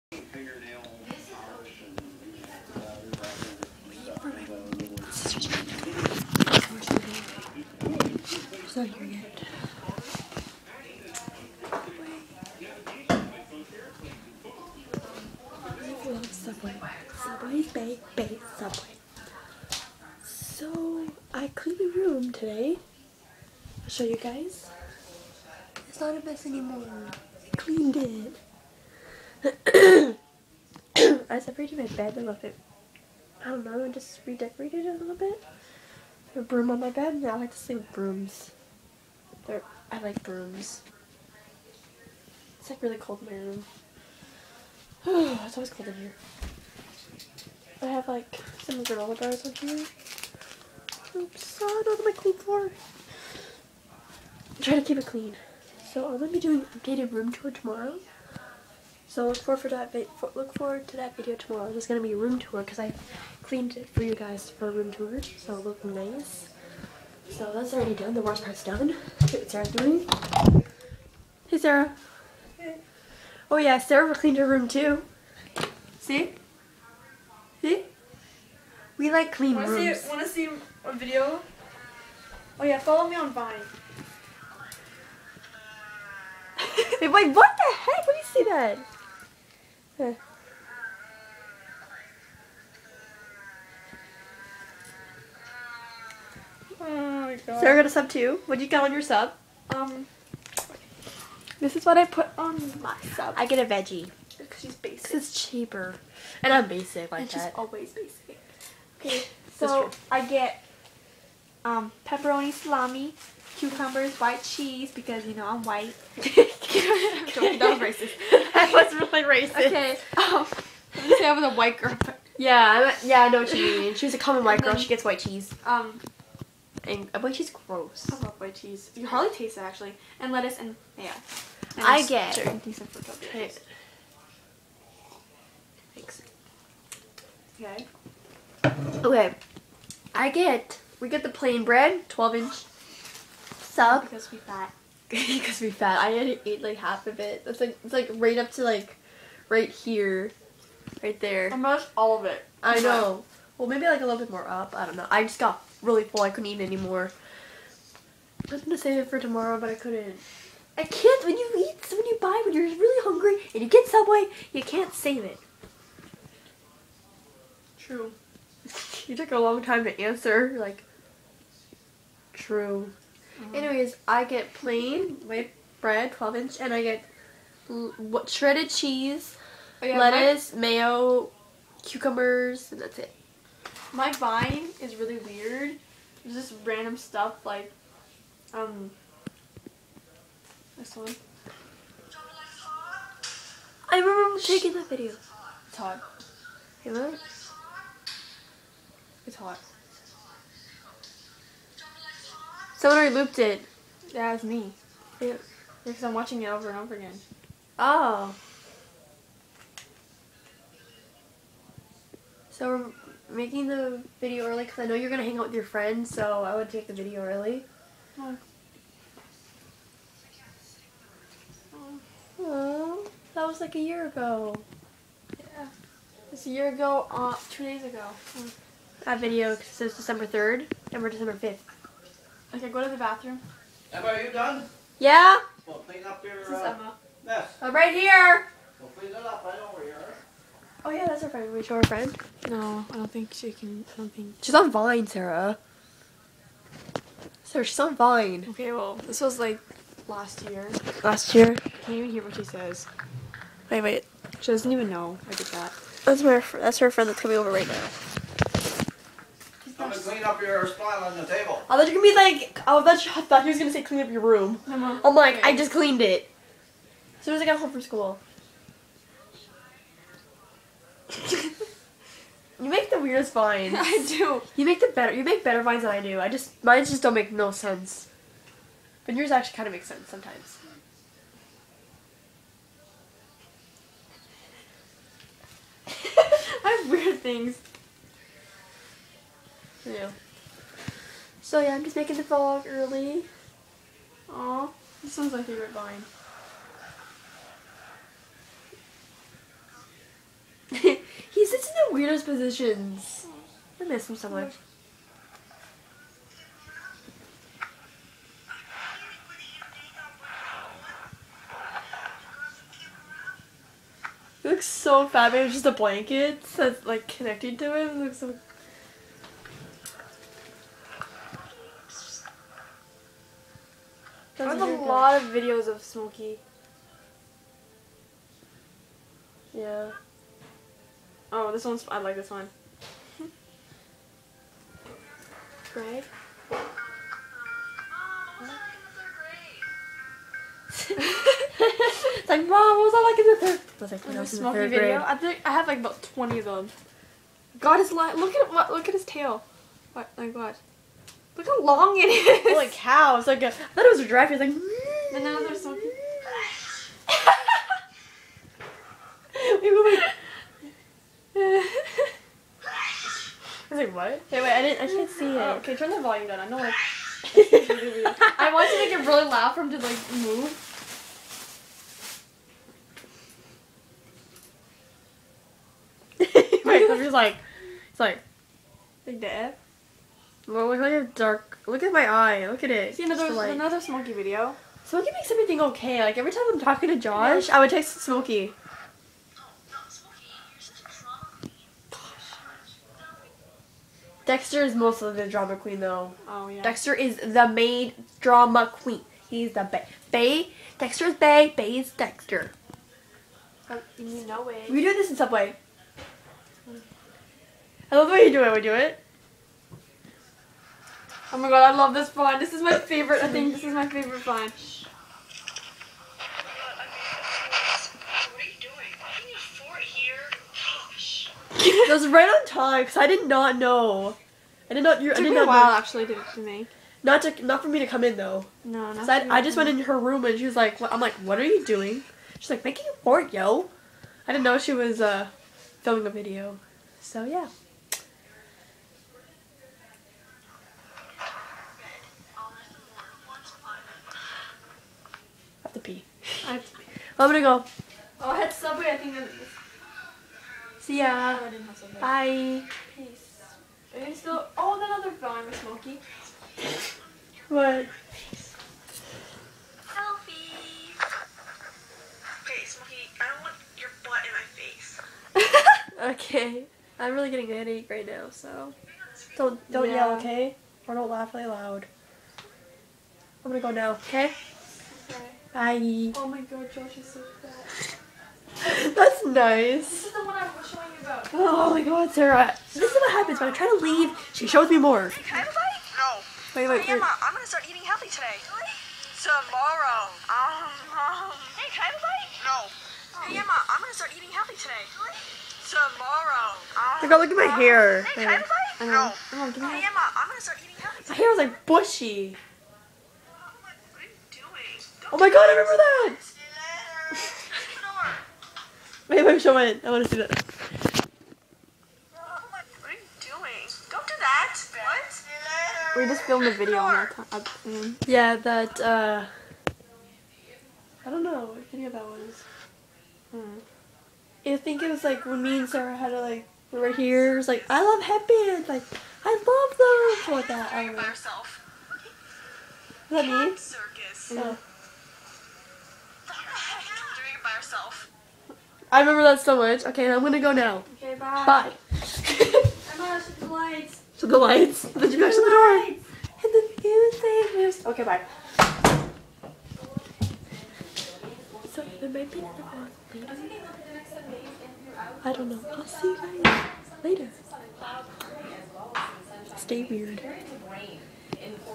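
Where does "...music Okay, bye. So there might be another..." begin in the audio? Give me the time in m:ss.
9:07.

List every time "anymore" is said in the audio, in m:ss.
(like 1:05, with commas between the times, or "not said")
0:26, 2:36.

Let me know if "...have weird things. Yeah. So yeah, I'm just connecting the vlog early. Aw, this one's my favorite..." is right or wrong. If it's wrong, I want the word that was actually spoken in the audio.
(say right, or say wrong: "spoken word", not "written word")
wrong: "making", not "connecting".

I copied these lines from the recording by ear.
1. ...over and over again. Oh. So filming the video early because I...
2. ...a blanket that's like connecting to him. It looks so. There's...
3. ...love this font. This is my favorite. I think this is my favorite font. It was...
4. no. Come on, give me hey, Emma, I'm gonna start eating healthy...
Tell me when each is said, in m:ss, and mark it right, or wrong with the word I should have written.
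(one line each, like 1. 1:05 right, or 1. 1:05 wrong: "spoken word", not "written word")
1. 3:26 wrong: "making", not "filming"
2. 5:15 right
3. 6:51 right
4. 8:19 right.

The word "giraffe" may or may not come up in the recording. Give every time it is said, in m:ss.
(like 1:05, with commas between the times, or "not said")
5:54.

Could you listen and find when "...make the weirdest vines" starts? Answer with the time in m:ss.
4:32.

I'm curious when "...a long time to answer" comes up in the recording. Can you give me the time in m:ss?
2:49.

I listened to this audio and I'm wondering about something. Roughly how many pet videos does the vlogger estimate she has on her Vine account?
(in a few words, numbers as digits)
About 20.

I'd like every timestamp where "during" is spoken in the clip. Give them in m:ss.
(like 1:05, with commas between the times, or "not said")
not said.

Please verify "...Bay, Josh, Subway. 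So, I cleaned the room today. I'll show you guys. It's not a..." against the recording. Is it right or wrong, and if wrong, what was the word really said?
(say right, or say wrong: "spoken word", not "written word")
wrong: "Bay", not "Josh".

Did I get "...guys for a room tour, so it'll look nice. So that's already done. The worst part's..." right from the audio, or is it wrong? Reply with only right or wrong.
right.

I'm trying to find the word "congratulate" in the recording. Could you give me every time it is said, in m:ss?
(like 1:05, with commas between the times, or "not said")
not said.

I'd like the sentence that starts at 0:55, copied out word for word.
So I'm gonna be doing updated room tour tomorrow.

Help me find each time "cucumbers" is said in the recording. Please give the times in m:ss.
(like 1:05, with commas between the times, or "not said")
1:53, 3:01.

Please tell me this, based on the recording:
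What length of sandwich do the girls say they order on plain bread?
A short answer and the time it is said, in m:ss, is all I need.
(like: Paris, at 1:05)
12 inch, at 2:22.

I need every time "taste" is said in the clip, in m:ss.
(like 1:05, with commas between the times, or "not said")
2:09.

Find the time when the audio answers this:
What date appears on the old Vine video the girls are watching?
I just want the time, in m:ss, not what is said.
3:49.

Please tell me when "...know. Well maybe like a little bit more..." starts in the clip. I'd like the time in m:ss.
2:32.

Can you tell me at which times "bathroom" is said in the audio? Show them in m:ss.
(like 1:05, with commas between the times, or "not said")
3:52.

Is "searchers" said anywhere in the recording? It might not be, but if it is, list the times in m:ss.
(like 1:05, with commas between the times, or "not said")
not said.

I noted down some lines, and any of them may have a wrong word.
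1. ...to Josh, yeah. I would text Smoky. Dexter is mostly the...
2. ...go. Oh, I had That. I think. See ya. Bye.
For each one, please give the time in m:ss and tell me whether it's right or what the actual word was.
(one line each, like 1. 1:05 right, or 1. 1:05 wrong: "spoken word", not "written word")
1. 6:26 right
2. 7:27 wrong: "Subway", not "That".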